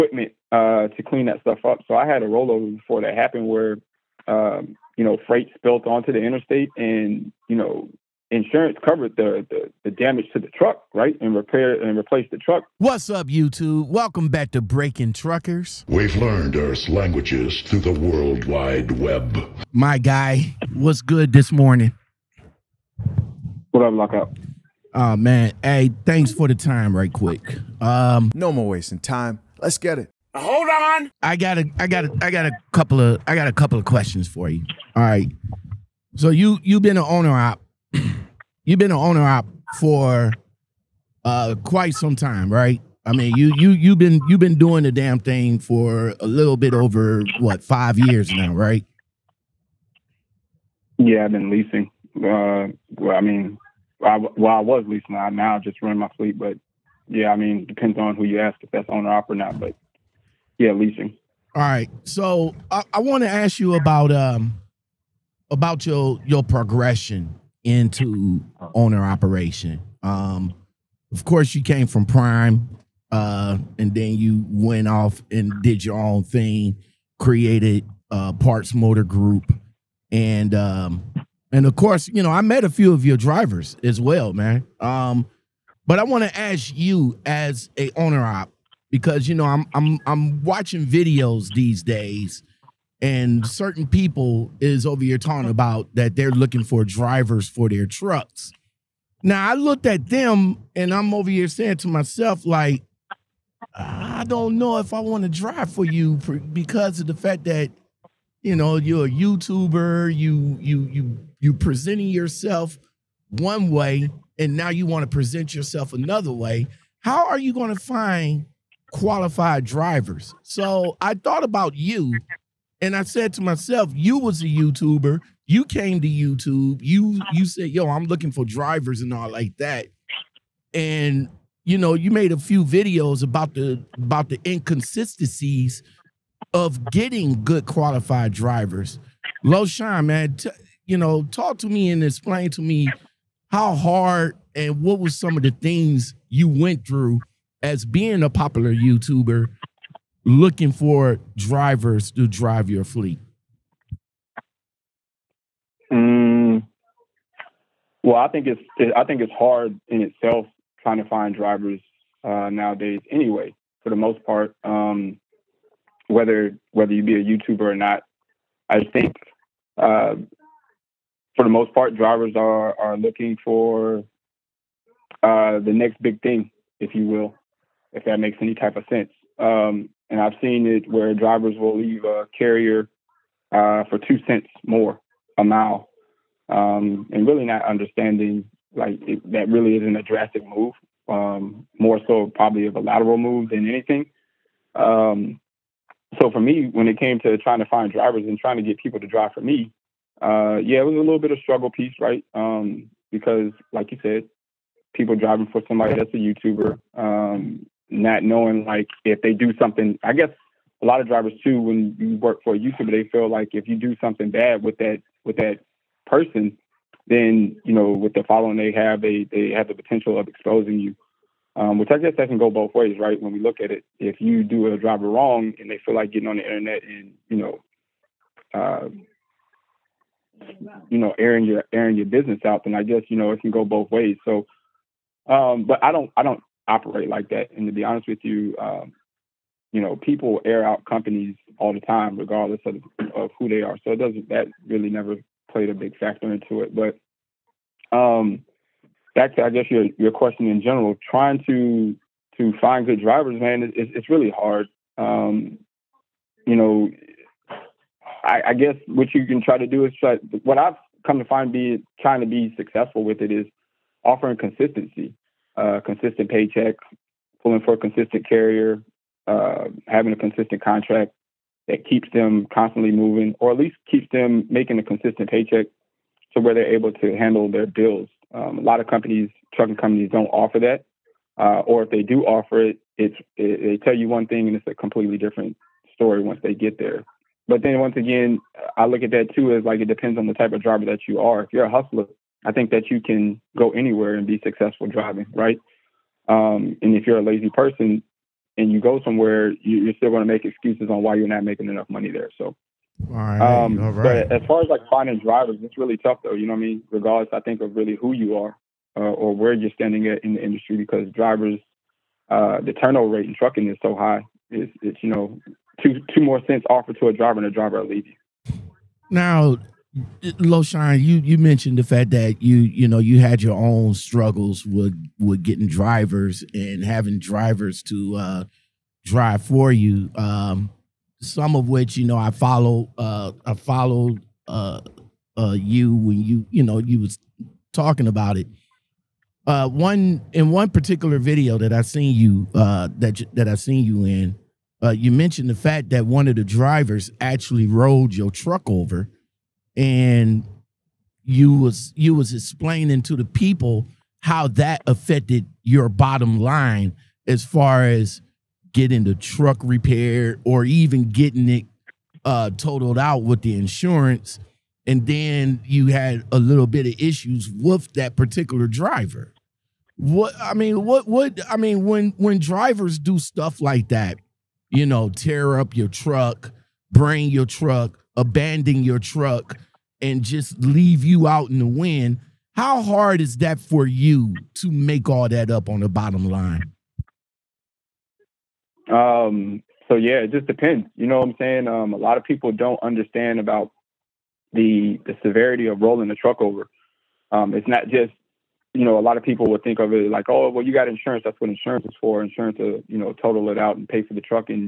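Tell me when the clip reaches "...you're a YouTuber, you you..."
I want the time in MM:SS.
01:48.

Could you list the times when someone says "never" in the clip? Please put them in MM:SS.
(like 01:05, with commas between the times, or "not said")
04:04.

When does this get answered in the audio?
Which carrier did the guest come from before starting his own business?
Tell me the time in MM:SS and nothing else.
01:12.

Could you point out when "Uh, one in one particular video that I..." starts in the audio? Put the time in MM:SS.
05:39.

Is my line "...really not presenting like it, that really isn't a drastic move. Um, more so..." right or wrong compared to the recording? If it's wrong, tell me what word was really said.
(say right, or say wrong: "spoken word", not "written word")
wrong: "understanding", not "presenting".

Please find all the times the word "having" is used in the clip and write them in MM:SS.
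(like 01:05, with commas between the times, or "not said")
04:29, 05:26.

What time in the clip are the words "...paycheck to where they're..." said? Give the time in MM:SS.
04:35.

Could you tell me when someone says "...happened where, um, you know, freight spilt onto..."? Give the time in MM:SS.
00:03.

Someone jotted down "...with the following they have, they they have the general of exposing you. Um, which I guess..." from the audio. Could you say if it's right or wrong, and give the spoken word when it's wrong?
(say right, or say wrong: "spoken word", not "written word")
wrong: "potential", not "general".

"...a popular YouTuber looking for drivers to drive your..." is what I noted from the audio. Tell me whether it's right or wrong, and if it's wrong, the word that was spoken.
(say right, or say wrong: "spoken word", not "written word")
right.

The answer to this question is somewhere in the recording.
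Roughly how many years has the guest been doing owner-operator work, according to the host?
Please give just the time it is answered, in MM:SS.
00:47.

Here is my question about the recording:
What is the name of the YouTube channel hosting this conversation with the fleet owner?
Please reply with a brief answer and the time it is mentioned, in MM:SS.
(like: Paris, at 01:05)
Breaking Truckers, at 00:14.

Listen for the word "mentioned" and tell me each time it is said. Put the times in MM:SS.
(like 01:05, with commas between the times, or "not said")
05:21, 05:45.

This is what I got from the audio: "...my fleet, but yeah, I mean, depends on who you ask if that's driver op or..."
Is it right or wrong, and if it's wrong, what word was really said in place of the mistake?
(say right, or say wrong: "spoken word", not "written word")
wrong: "owner", not "driver".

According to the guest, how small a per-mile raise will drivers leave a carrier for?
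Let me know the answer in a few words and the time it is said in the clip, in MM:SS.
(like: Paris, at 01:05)
2 cents, at 03:03.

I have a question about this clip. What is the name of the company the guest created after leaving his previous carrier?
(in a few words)
Parks Motor Group.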